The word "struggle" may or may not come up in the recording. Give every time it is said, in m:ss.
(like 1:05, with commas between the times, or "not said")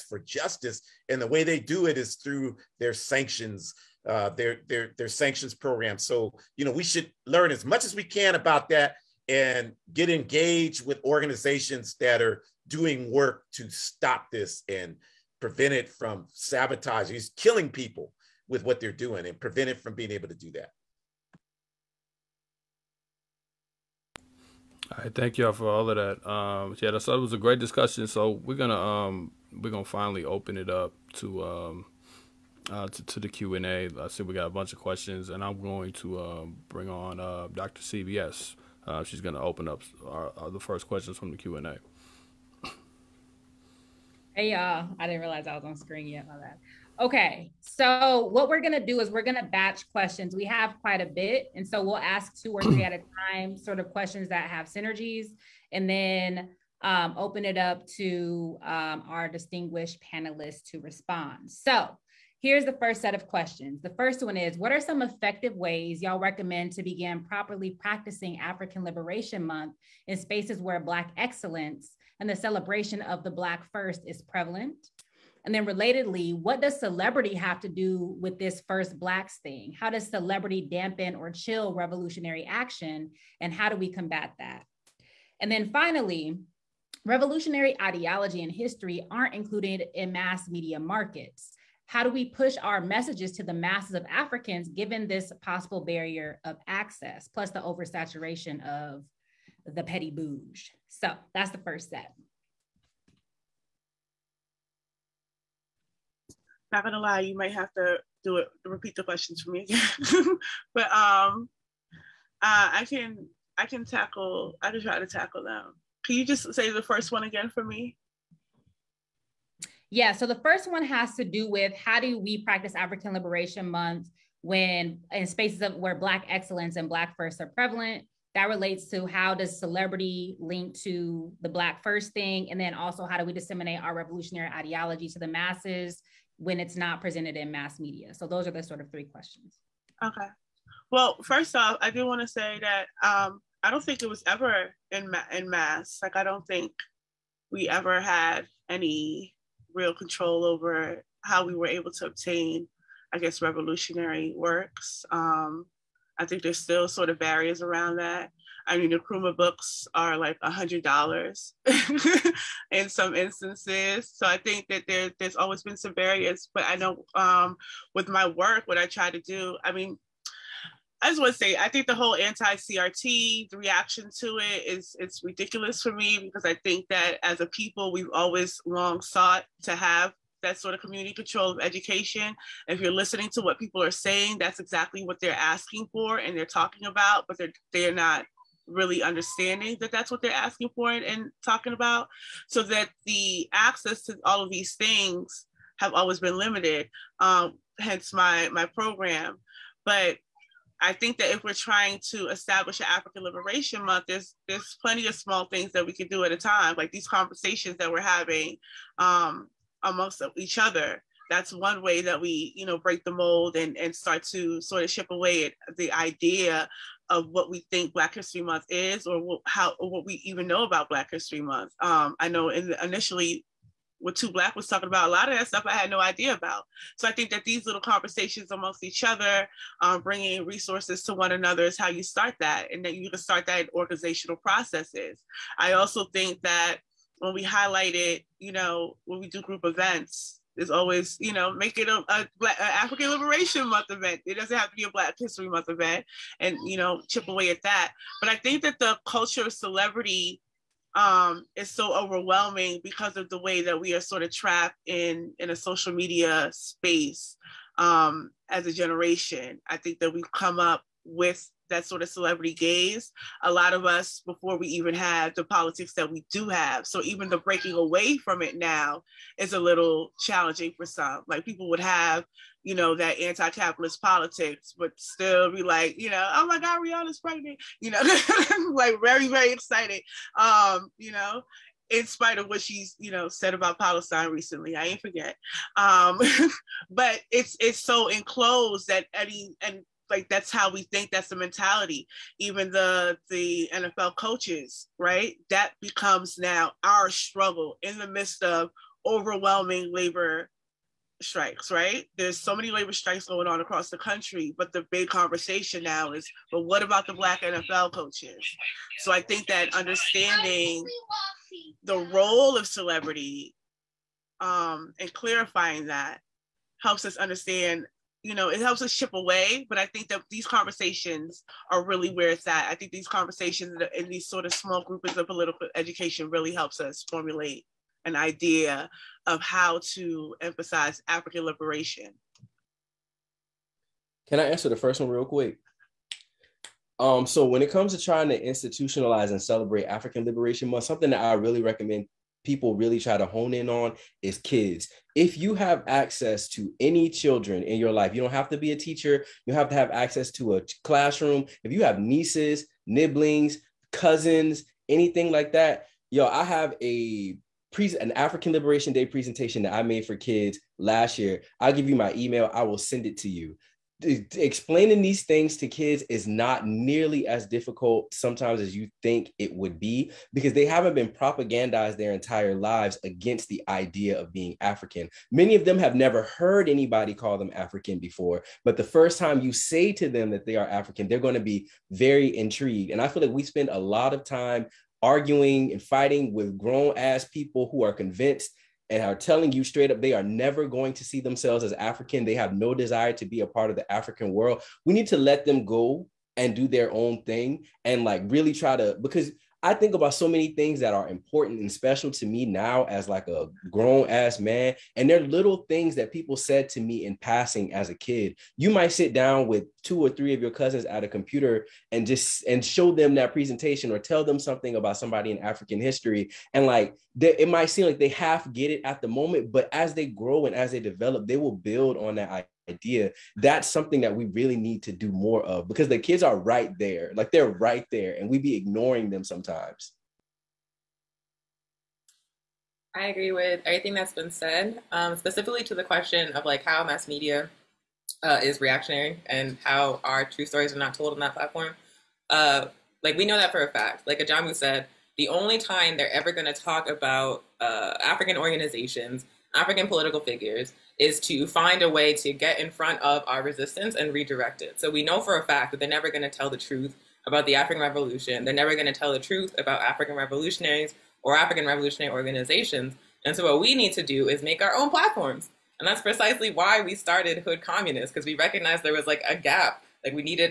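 4:57.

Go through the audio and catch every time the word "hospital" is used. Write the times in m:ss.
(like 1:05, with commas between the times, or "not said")
not said.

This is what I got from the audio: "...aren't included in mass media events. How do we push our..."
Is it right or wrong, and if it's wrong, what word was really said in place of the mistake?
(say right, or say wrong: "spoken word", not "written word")
wrong: "markets", not "events".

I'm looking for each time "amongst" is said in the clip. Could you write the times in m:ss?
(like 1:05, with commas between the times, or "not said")
3:29, 3:48.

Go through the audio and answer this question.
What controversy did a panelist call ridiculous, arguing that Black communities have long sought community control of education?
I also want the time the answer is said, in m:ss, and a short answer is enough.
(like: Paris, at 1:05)
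anti-CRT, at 2:52.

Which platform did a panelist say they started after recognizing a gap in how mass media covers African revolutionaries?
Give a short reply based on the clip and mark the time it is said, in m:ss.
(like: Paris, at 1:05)
Hood Communists, at 7:47.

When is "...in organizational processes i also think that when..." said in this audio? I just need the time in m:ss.
3:53.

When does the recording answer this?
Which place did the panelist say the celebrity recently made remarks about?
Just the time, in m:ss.
4:43.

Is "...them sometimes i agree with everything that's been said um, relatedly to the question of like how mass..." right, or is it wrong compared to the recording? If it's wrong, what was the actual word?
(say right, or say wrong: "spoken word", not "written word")
wrong: "specifically", not "relatedly".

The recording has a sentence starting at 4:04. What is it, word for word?
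It doesn't have to be a Black History Month event, and you know, chip away at that.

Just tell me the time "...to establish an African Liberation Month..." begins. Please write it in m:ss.
3:22.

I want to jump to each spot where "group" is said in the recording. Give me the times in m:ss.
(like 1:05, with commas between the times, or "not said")
3:59, 5:24.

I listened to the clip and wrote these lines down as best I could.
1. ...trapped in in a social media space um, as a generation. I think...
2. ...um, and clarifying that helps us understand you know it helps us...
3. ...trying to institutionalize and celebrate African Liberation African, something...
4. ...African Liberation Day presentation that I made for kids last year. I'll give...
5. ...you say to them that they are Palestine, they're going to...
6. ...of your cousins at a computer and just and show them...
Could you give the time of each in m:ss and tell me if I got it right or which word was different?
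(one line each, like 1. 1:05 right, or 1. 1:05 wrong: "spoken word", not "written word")
1. 4:14 right
2. 5:14 right
3. 5:38 wrong: "Month", not "African"
4. 5:58 right
5. 6:19 wrong: "African", not "Palestine"
6. 6:50 right.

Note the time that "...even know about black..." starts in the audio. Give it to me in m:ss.
3:40.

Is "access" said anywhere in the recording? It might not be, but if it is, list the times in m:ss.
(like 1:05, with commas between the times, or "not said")
1:36, 3:13, 5:45, 5:49.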